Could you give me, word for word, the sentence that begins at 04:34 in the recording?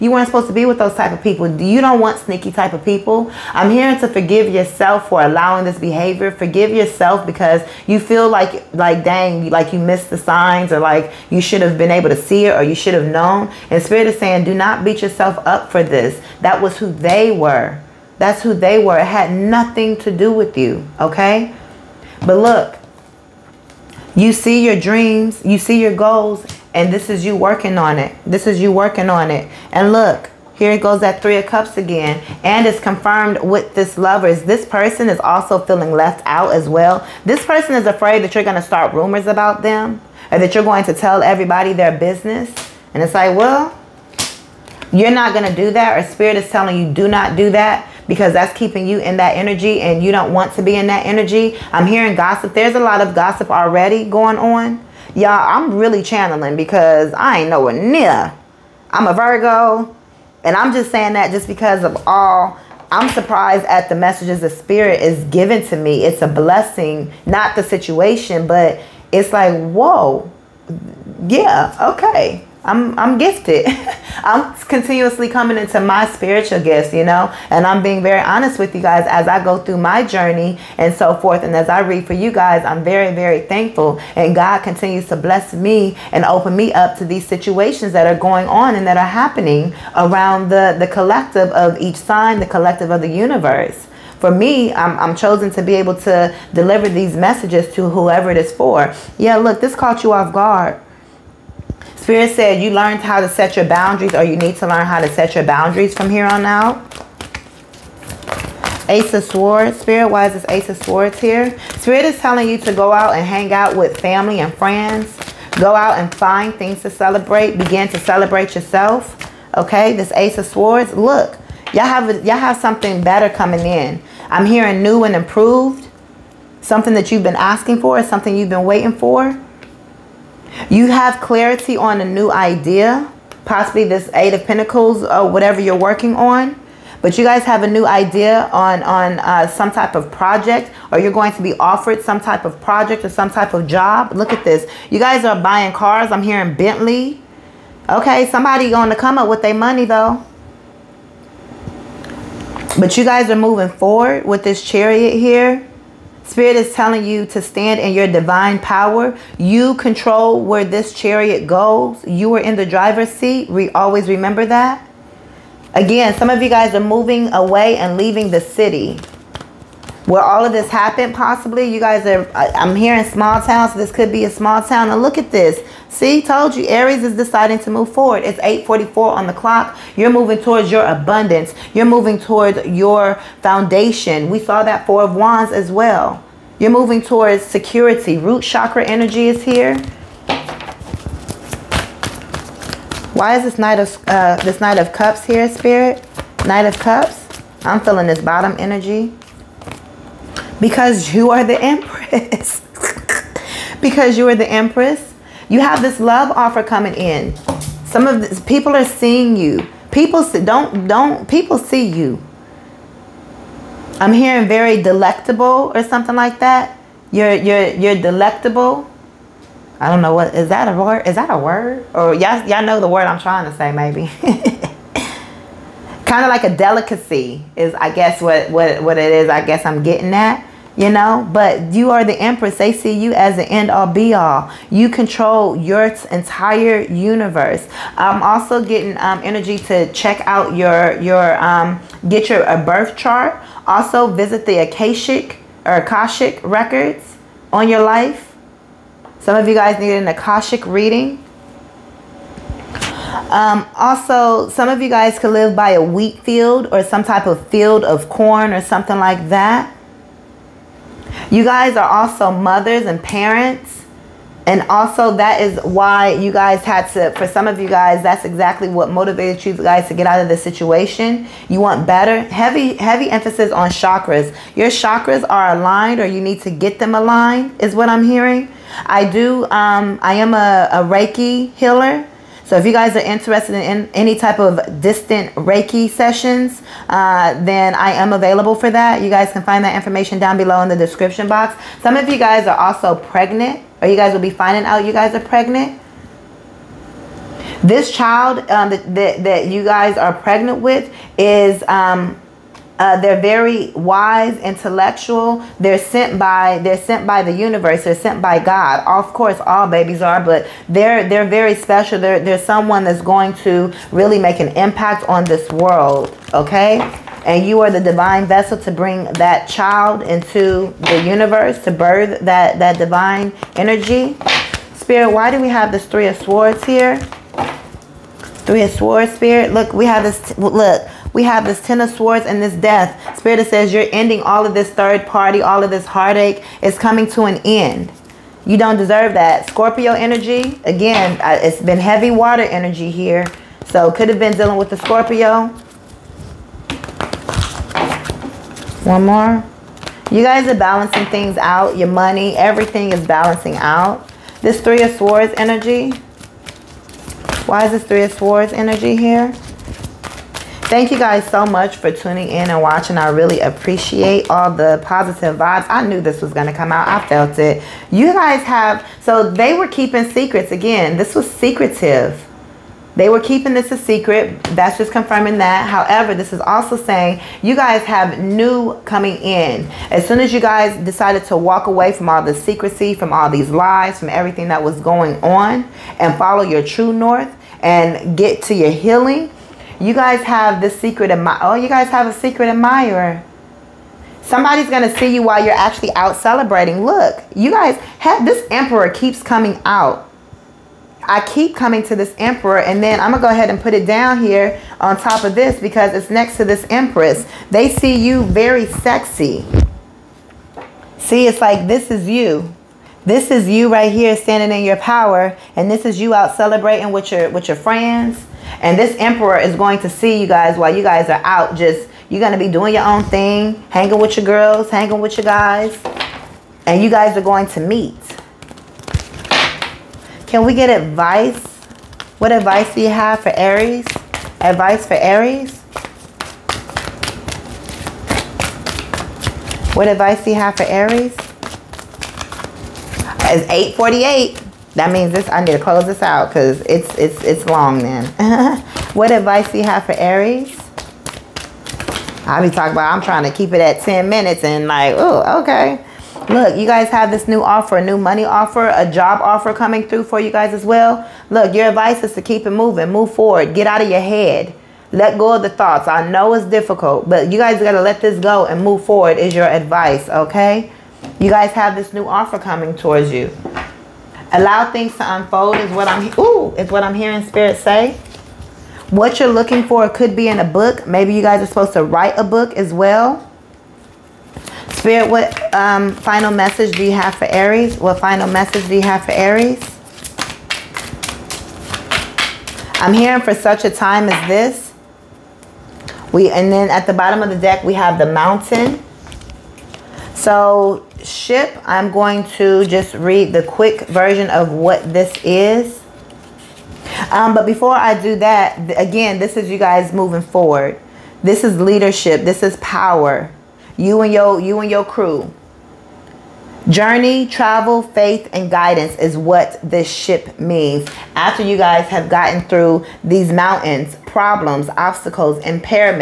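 Your chakras are aligned or you need to get them aligned is what I'm hearing.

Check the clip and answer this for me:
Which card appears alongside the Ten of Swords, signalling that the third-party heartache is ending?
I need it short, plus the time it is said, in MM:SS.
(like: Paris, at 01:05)
Death, at 05:32.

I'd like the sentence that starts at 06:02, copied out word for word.
I really appreciate all the positive vibes.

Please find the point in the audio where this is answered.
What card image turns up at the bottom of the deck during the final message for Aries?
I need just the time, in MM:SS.
08:17.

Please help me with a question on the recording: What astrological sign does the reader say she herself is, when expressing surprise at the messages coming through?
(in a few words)
Virgo.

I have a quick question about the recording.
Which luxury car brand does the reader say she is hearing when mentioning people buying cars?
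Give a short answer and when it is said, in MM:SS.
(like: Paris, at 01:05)
Bentley, at 02:26.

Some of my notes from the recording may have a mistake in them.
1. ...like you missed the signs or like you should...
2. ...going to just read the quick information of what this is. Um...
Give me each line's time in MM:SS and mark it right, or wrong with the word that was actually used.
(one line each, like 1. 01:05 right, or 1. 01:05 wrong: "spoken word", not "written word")
1. 00:09 right
2. 08:21 wrong: "version", not "information".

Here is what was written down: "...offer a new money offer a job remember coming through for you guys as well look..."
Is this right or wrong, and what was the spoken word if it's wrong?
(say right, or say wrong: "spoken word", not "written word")
wrong: "offer", not "remember".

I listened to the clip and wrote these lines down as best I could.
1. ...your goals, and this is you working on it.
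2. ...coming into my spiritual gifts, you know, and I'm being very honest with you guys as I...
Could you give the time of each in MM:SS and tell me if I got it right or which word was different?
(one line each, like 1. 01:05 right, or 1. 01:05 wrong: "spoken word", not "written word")
1. 00:25 right
2. 01:15 right.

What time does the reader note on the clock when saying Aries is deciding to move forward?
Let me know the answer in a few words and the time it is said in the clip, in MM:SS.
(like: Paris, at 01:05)
8:44, at 02:58.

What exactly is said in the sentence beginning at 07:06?
And you guys are going to meet.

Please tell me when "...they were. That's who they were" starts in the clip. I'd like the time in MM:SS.
00:16.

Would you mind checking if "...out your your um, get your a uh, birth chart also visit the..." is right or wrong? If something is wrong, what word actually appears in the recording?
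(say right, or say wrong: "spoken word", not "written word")
right.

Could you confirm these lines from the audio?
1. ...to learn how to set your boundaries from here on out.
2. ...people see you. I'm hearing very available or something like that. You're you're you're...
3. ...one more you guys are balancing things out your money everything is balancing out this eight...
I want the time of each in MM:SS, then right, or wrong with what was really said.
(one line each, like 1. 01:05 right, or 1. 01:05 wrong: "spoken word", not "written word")
1. 01:44 right
2. 03:31 wrong: "delectable", not "available"
3. 05:48 wrong: "three", not "eight".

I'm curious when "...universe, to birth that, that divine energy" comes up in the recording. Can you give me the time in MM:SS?
05:21.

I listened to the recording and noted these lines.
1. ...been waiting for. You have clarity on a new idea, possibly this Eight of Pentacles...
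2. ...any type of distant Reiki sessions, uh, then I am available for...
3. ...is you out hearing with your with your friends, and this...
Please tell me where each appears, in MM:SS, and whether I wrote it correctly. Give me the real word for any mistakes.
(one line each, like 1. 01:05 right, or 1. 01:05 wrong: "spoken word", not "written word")
1. 02:08 right
2. 04:43 right
3. 06:55 wrong: "celebrating", not "hearing".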